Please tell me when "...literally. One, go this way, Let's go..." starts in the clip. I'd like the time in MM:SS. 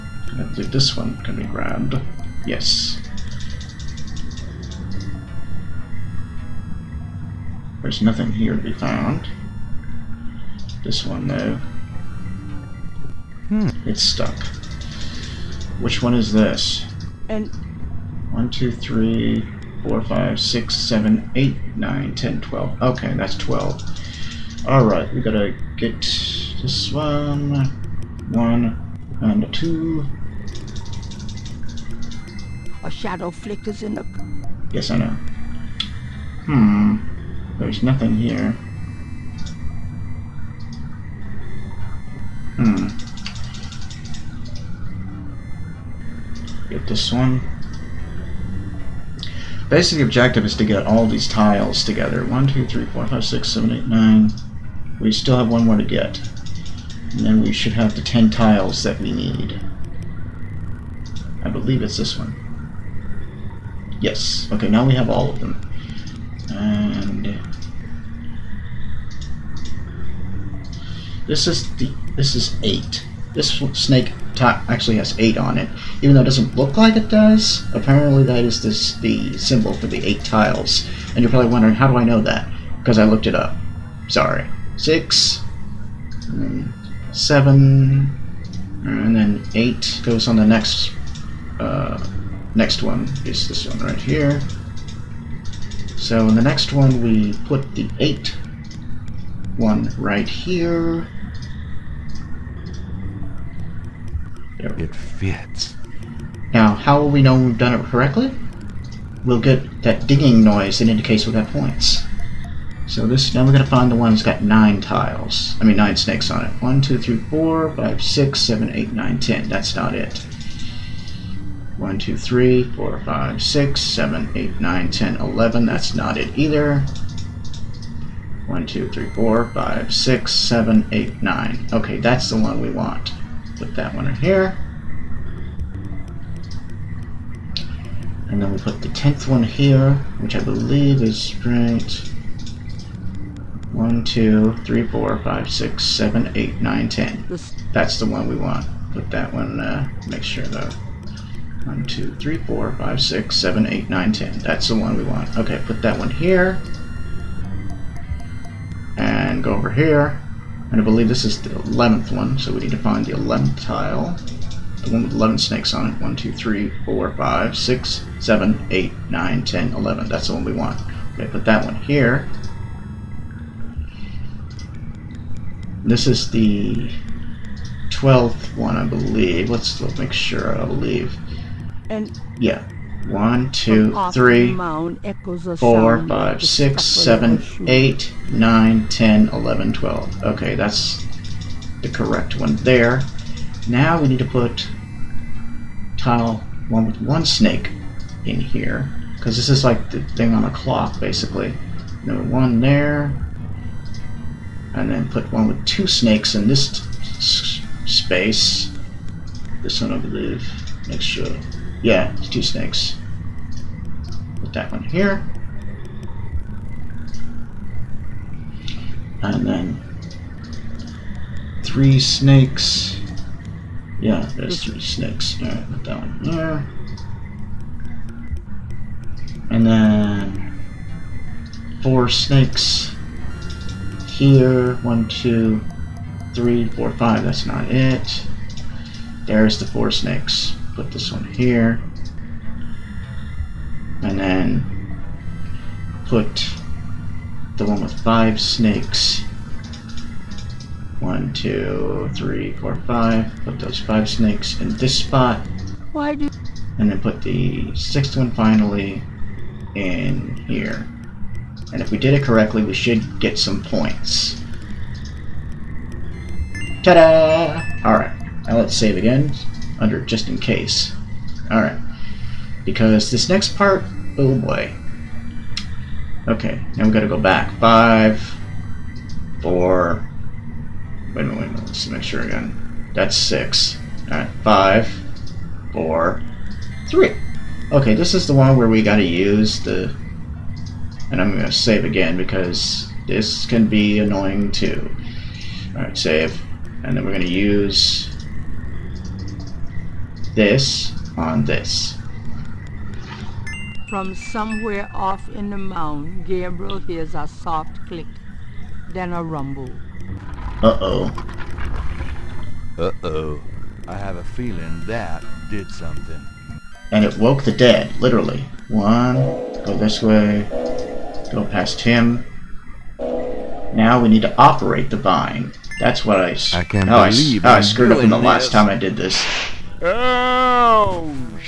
05:17.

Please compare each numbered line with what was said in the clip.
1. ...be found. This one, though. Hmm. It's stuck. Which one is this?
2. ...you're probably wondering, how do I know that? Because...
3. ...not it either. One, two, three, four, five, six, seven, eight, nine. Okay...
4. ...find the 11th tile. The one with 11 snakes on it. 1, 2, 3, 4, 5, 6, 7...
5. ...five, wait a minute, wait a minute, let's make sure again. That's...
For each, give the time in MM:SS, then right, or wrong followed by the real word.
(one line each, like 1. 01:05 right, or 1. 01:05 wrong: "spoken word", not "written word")
1. 00:08 right
2. 01:21 right
3. 02:05 right
4. 02:42 right
5. 04:39 wrong: "four", not "five".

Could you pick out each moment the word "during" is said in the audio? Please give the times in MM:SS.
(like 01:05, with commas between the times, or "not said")
not said.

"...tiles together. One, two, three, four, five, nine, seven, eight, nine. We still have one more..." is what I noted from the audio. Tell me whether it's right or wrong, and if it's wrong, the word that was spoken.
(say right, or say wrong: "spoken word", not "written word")
wrong: "six", not "nine".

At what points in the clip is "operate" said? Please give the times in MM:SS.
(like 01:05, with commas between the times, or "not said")
05:24.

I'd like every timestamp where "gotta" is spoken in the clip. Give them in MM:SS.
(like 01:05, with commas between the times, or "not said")
00:25, 04:36, 04:48.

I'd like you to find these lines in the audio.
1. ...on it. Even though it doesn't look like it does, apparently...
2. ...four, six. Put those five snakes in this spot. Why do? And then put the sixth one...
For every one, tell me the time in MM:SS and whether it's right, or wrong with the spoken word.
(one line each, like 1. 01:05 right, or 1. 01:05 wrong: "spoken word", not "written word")
1. 01:15 right
2. 04:12 wrong: "five", not "six".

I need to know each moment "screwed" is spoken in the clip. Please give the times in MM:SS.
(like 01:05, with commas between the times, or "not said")
05:27.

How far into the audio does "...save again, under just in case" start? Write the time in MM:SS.
04:28.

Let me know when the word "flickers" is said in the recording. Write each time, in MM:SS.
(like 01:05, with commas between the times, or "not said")
00:33.